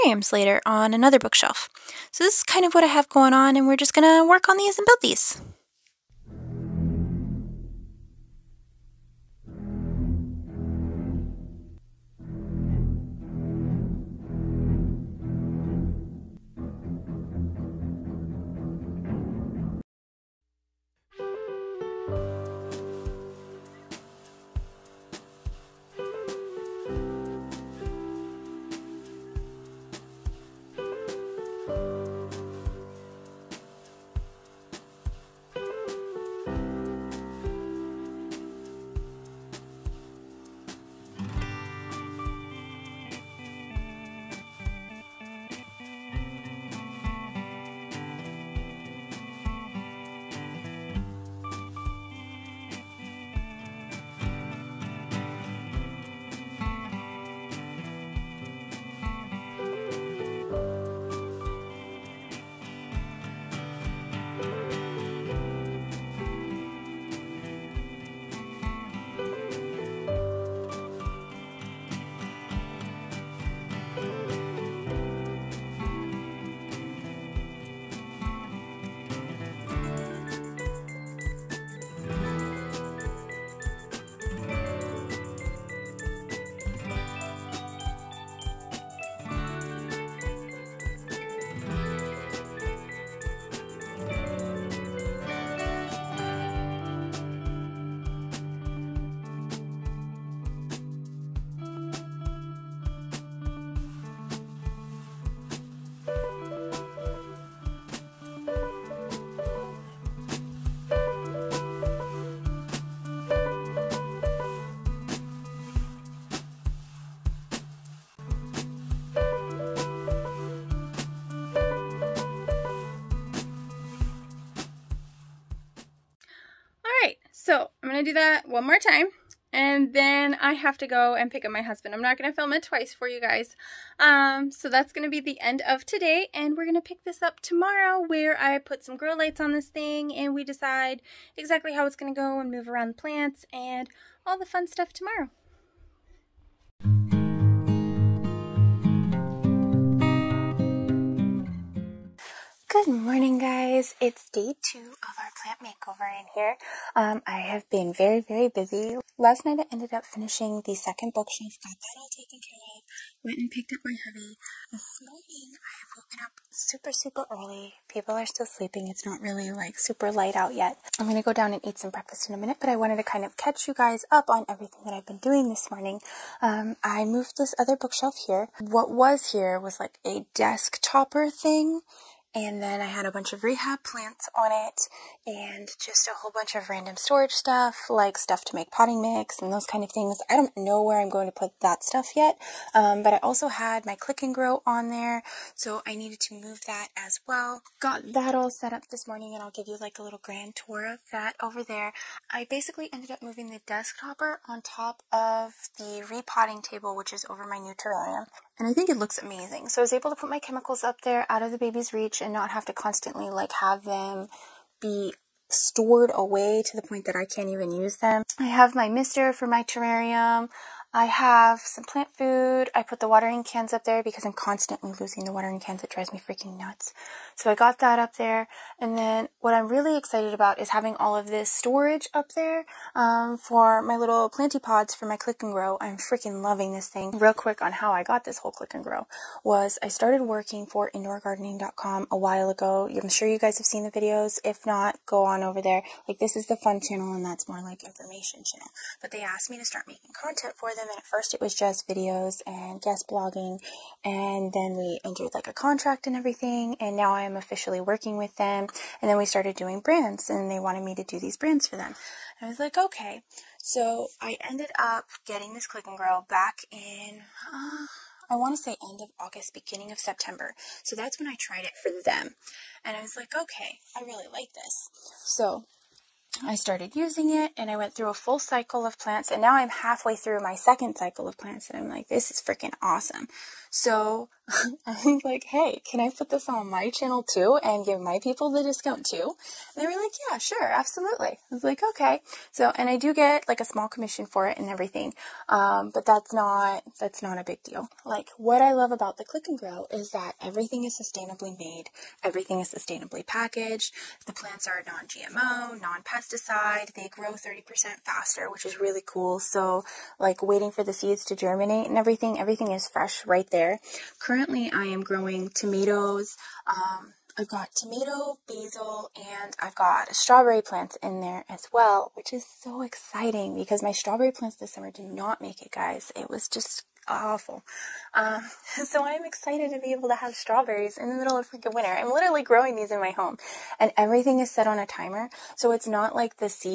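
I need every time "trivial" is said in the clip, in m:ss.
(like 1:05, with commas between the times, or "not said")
not said.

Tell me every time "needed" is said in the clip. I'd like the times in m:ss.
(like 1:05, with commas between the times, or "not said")
3:15.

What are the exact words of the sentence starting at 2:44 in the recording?
This morning I have woken up super, super early.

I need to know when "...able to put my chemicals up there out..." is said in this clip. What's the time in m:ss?
3:29.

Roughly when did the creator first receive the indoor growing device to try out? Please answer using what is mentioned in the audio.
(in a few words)
End of August.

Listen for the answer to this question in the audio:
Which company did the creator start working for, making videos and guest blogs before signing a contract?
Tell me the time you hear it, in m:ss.
4:00.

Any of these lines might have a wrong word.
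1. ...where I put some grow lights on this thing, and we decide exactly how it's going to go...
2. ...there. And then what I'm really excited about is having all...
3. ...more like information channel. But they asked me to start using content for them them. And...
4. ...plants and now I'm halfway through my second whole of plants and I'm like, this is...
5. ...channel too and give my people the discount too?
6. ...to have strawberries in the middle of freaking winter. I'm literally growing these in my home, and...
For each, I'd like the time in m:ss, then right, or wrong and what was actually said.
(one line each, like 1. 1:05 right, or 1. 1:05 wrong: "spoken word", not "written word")
1. 2:18 right
2. 3:48 right
3. 4:07 wrong: "making", not "using"
4. 4:38 wrong: "cycle", not "whole"
5. 4:46 right
6. 5:30 right.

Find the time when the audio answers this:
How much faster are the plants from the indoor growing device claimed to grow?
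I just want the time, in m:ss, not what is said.
5:07.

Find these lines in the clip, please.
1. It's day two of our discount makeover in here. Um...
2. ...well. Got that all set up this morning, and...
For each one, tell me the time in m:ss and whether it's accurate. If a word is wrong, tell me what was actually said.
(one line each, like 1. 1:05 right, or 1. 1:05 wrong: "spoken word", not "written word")
1. 2:33 wrong: "plant", not "discount"
2. 3:17 right.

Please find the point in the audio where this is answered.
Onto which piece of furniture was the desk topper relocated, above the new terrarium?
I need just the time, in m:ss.
3:26.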